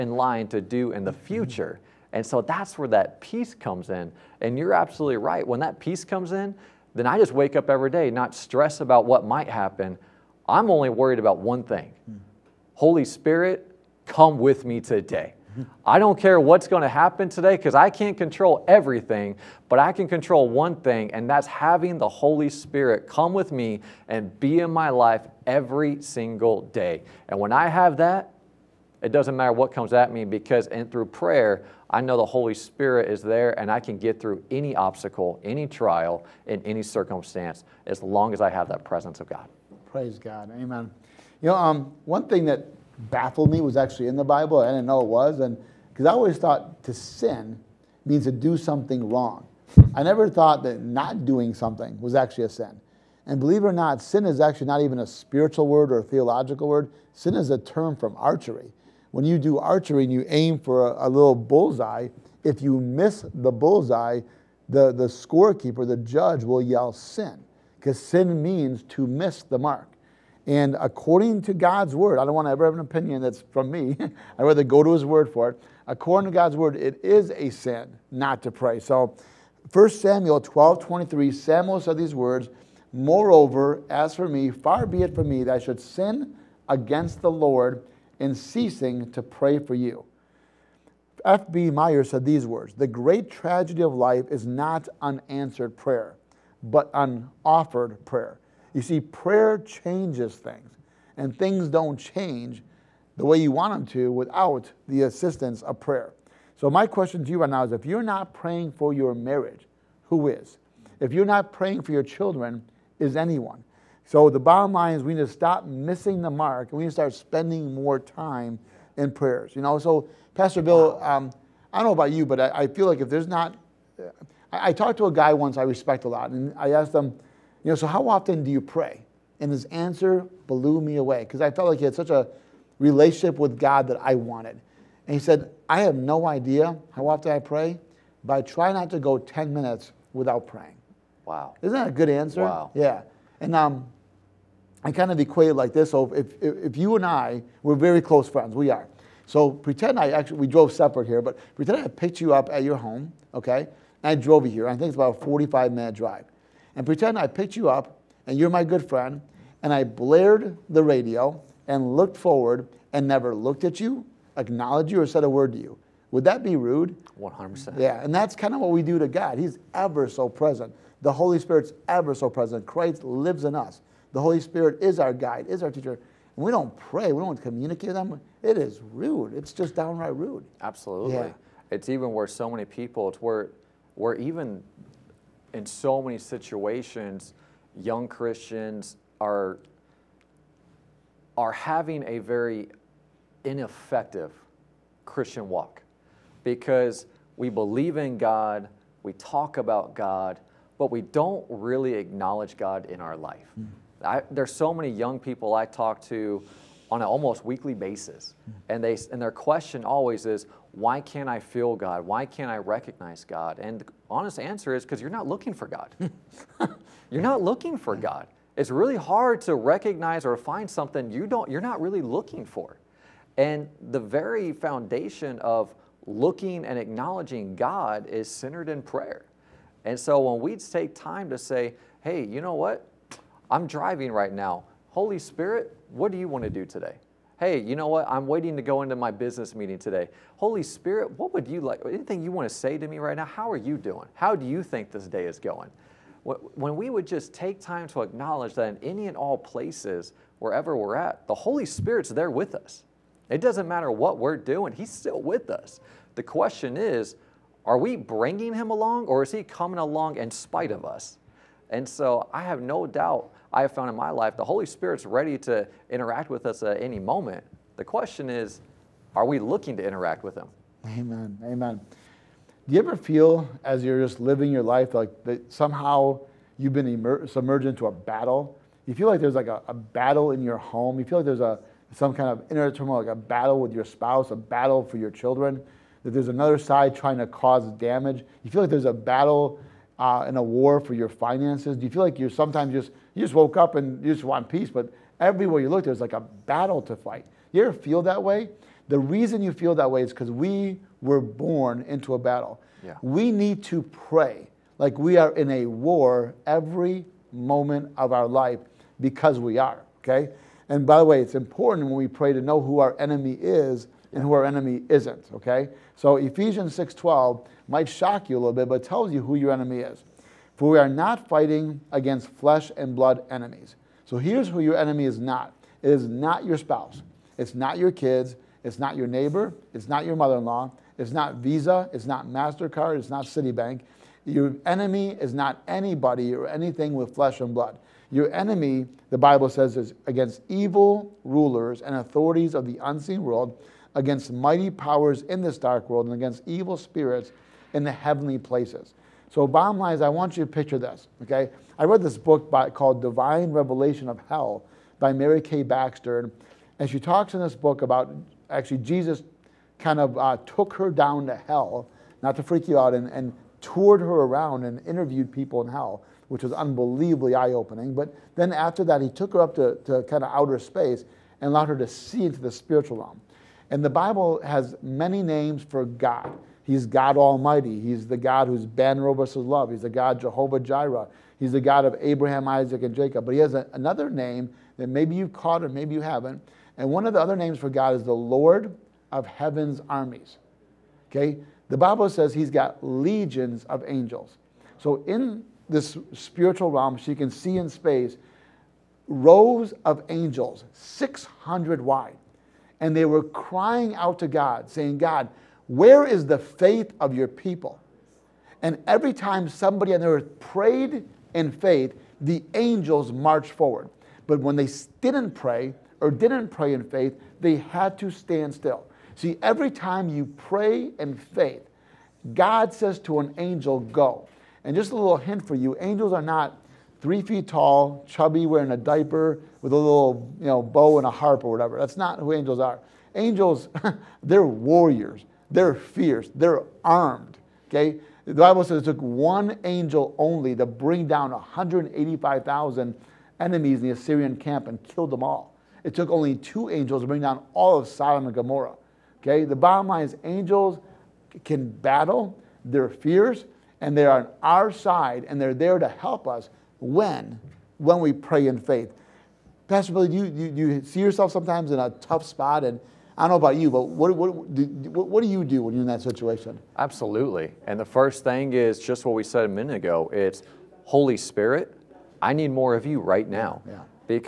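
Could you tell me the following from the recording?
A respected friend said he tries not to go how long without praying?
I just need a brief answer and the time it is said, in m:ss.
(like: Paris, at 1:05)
10 minutes, at 2:19.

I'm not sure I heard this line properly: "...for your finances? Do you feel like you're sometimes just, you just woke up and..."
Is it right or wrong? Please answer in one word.
right.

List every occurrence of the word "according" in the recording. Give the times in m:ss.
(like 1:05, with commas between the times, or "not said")
1:10, 1:15.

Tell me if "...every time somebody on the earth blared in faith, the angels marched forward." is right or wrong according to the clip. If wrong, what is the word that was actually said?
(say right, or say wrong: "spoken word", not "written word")
wrong: "prayed", not "blared".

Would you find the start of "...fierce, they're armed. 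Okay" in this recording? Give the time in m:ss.
7:15.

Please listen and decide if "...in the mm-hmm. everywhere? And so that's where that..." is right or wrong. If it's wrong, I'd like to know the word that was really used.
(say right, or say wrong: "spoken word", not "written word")
wrong: "future", not "everywhere".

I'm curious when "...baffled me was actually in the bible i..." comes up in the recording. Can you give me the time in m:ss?
0:43.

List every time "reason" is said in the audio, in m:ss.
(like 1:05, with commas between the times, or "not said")
4:58.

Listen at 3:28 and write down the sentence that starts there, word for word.
and they and their question always is, "Why can't I feel God?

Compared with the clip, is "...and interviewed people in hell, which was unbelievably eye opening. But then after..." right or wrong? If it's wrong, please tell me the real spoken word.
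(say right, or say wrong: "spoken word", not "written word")
right.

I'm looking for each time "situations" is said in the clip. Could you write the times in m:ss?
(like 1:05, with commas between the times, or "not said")
3:06, 7:46.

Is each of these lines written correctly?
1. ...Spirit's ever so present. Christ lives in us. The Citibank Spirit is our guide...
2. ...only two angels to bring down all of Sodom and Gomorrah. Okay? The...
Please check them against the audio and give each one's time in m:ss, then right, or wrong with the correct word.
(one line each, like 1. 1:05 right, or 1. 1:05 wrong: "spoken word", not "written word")
1. 2:51 wrong: "Holy", not "Citibank"
2. 7:26 right.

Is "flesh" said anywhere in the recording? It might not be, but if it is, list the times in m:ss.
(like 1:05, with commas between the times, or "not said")
5:22, 5:37.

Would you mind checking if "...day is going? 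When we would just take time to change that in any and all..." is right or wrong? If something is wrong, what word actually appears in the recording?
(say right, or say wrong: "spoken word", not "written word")
wrong: "acknowledge", not "change".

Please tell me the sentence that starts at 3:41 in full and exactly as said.
You're not really looking for, and the very foundation of looking and acknowledging God is centered in prayer.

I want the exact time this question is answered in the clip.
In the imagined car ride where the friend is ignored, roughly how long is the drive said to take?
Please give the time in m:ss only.
2:35.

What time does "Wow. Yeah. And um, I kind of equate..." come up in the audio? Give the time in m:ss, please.
2:22.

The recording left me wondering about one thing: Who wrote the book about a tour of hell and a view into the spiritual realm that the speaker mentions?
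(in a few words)
Mary K. Baxter.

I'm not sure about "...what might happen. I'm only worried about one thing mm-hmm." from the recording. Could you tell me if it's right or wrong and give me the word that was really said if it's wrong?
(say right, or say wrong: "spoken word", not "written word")
right.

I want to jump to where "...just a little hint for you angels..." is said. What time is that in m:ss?
7:04.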